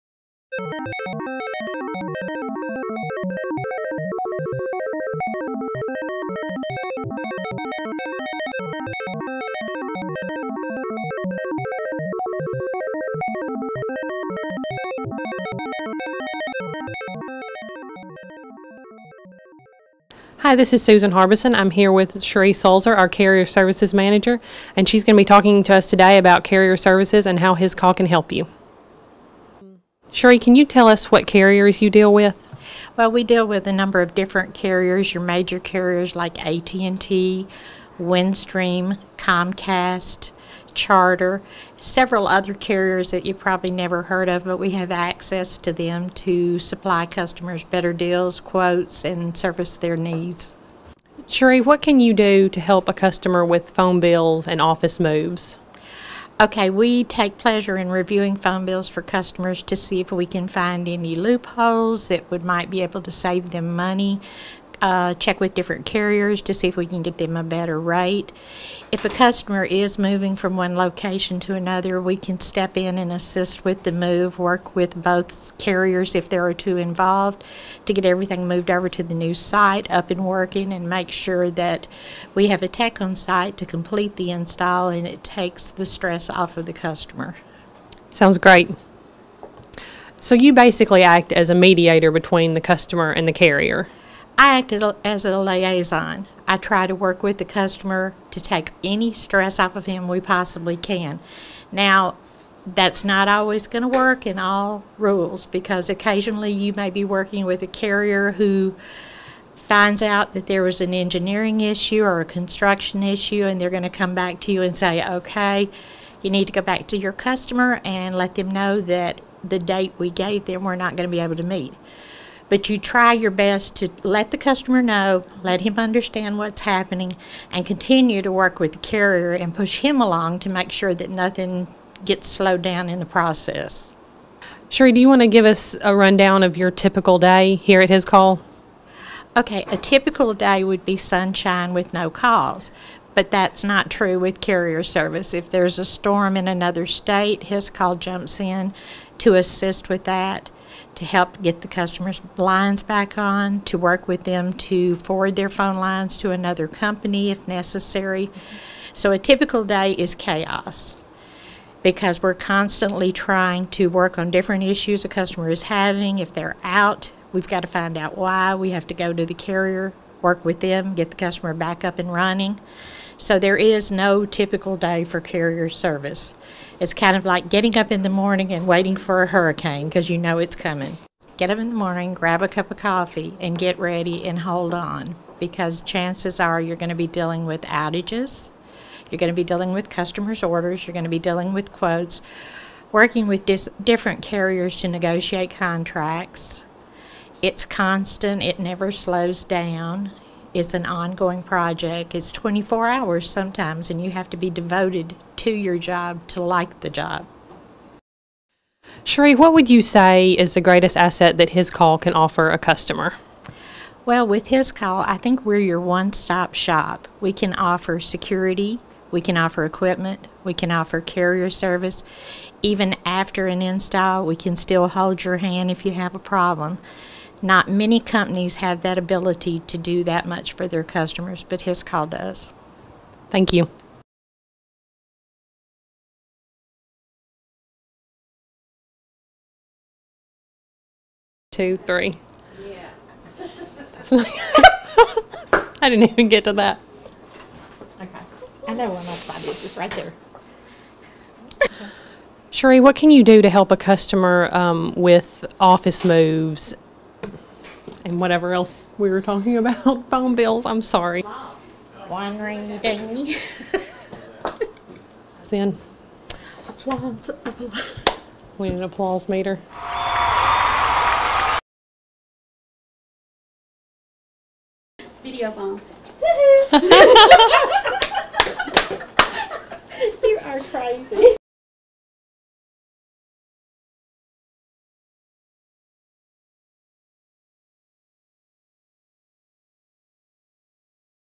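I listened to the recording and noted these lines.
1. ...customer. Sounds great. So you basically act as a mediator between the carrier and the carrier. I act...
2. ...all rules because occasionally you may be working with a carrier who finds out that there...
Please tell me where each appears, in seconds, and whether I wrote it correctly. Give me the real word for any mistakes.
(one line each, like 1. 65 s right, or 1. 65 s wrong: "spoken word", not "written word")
1. 86 s wrong: "customer", not "carrier"
2. 104 s right.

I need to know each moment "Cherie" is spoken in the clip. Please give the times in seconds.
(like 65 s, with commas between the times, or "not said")
22 s, 30 s, 51 s, 134 s, 209 s, 252 s.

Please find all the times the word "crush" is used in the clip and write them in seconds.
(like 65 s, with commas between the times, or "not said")
not said.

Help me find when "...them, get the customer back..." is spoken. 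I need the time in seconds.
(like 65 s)
170 s.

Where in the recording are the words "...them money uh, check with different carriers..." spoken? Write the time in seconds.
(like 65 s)
63 s.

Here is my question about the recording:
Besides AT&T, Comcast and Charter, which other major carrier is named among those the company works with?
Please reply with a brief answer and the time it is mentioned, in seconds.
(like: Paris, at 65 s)
Windstream, at 37 s.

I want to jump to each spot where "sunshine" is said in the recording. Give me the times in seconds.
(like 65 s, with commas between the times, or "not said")
140 s.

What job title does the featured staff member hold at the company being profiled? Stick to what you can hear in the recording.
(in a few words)
Carrier Services Manager.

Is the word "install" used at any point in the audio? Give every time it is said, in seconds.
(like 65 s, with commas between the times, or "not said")
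84 s, 223 s.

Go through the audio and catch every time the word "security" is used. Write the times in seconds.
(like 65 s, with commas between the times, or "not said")
217 s.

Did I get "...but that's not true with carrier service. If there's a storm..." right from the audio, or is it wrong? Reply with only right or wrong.
right.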